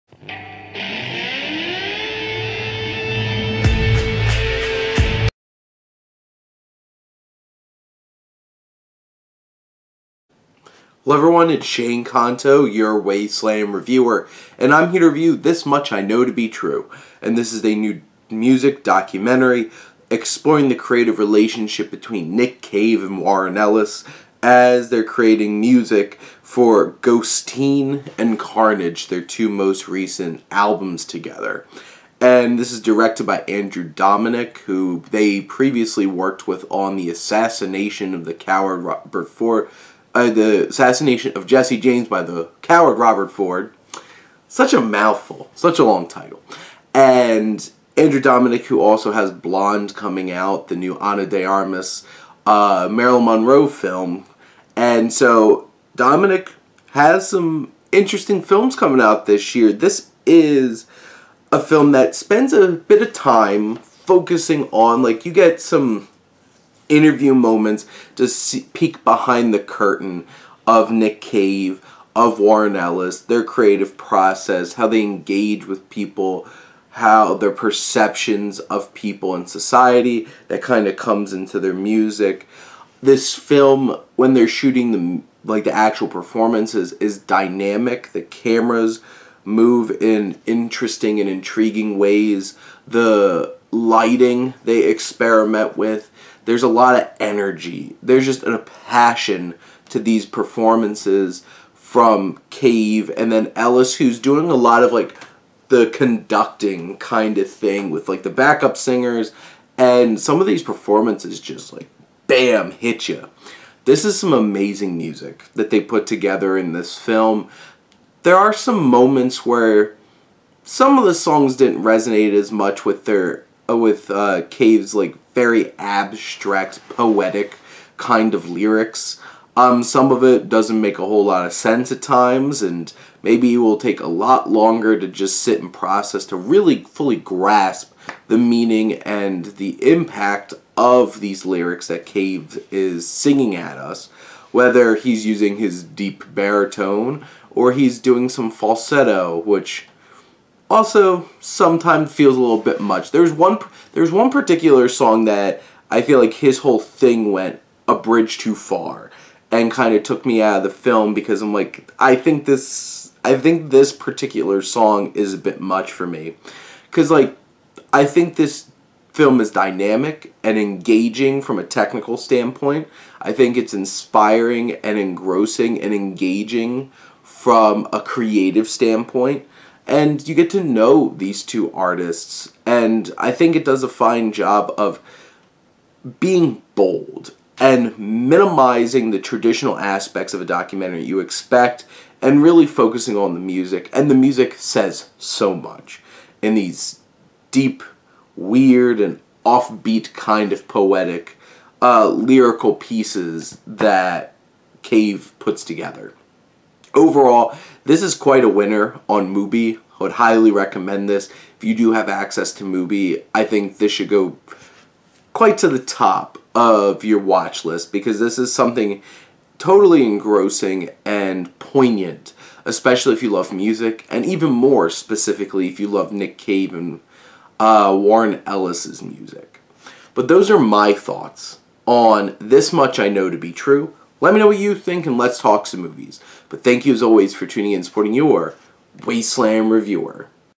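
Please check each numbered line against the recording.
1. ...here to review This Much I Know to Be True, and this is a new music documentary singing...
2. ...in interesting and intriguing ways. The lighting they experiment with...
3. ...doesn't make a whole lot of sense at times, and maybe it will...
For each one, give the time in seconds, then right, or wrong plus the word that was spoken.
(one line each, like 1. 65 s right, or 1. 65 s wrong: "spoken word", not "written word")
1. 14 s wrong: "exploring", not "singing"
2. 89 s right
3. 130 s right.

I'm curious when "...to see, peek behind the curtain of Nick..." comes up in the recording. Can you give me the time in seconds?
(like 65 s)
68 s.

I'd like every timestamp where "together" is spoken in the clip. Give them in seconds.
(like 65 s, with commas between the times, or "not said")
31 s, 116 s, 205 s.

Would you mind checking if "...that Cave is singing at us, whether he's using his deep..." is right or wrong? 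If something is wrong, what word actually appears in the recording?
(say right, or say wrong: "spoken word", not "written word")
right.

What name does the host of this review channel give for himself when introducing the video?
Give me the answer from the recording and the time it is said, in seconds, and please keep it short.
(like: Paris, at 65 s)
Shane Kanto, at 11 s.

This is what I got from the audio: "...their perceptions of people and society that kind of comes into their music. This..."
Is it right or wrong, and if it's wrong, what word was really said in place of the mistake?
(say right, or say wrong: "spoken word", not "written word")
right.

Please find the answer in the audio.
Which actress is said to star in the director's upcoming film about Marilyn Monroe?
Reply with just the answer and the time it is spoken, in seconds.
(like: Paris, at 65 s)
Ana de Armas, at 50 s.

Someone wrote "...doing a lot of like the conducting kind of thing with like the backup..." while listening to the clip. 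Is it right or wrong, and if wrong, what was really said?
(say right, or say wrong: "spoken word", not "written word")
right.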